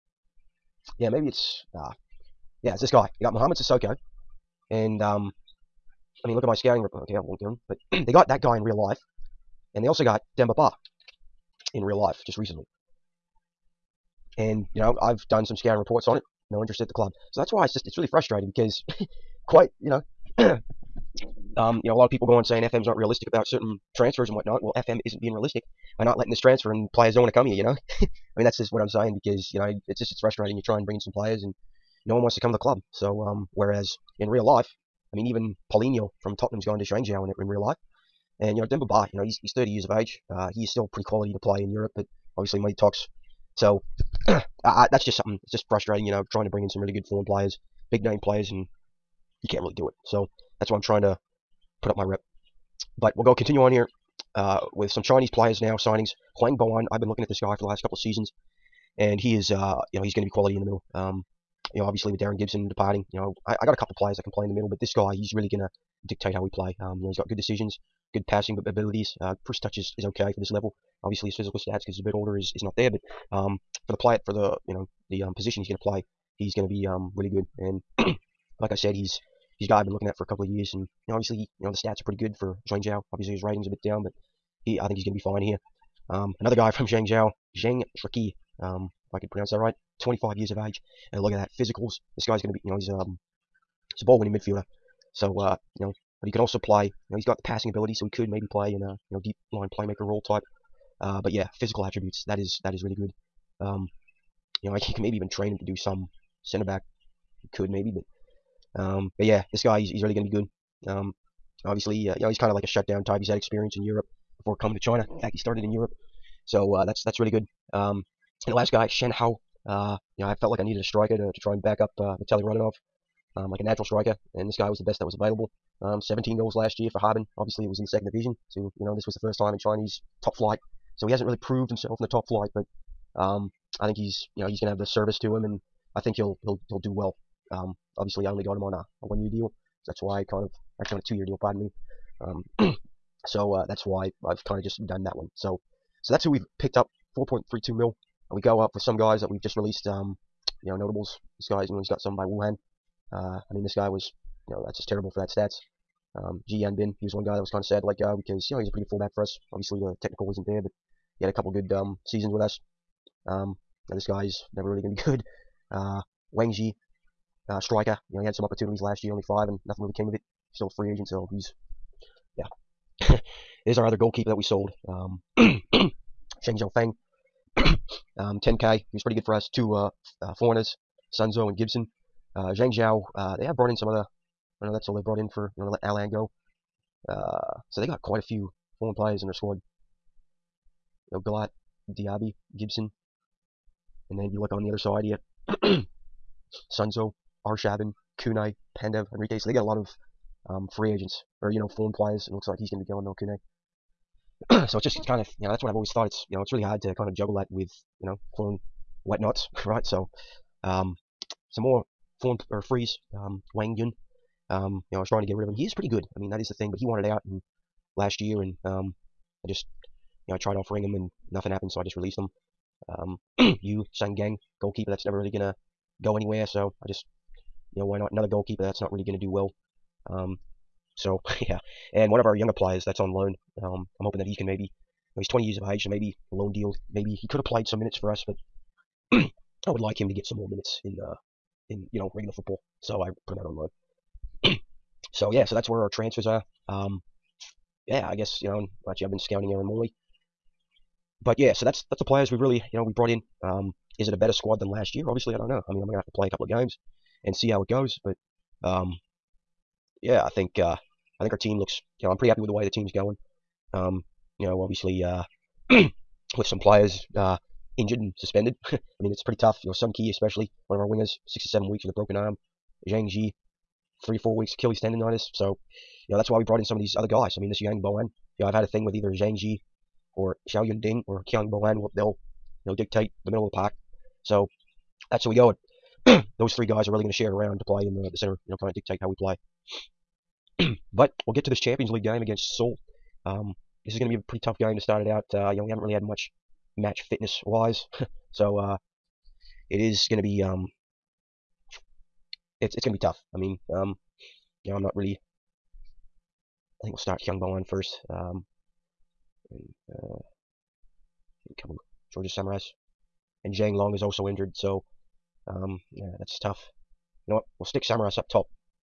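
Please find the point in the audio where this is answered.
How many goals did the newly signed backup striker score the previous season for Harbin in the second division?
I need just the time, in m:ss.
2:06.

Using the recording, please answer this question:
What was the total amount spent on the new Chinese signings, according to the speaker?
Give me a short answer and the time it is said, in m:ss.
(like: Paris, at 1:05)
4.32 mil, at 2:27.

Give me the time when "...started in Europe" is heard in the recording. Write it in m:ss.
1:55.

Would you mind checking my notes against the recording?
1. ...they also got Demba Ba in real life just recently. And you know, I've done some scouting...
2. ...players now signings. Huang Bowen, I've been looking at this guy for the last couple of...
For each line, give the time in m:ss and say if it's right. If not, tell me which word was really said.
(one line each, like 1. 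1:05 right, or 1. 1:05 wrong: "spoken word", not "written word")
1. 0:09 right
2. 0:55 right.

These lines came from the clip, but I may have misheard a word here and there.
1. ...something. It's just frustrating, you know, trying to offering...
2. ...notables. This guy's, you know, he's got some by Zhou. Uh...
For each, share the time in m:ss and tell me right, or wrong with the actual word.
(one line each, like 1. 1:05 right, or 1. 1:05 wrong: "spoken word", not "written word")
1. 0:45 wrong: "bring", not "offering"
2. 2:30 wrong: "Wuhan", not "Zhou".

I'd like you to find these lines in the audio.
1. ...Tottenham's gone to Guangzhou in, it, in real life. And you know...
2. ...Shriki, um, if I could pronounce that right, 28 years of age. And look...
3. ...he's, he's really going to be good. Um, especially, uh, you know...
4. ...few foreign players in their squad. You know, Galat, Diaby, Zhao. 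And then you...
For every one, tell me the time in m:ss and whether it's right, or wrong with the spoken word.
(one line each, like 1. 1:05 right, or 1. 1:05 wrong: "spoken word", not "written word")
1. 0:36 right
2. 1:27 wrong: "25", not "28"
3. 1:49 wrong: "obviously", not "especially"
4. 3:08 wrong: "Gibson", not "Zhao".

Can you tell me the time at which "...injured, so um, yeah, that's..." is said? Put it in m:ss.
5:14.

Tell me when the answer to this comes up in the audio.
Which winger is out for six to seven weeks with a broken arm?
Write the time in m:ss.
4:29.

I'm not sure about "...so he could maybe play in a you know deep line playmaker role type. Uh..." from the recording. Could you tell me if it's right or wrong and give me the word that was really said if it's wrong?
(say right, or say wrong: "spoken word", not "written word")
right.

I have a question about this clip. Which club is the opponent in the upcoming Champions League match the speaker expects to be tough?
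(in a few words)
Seoul.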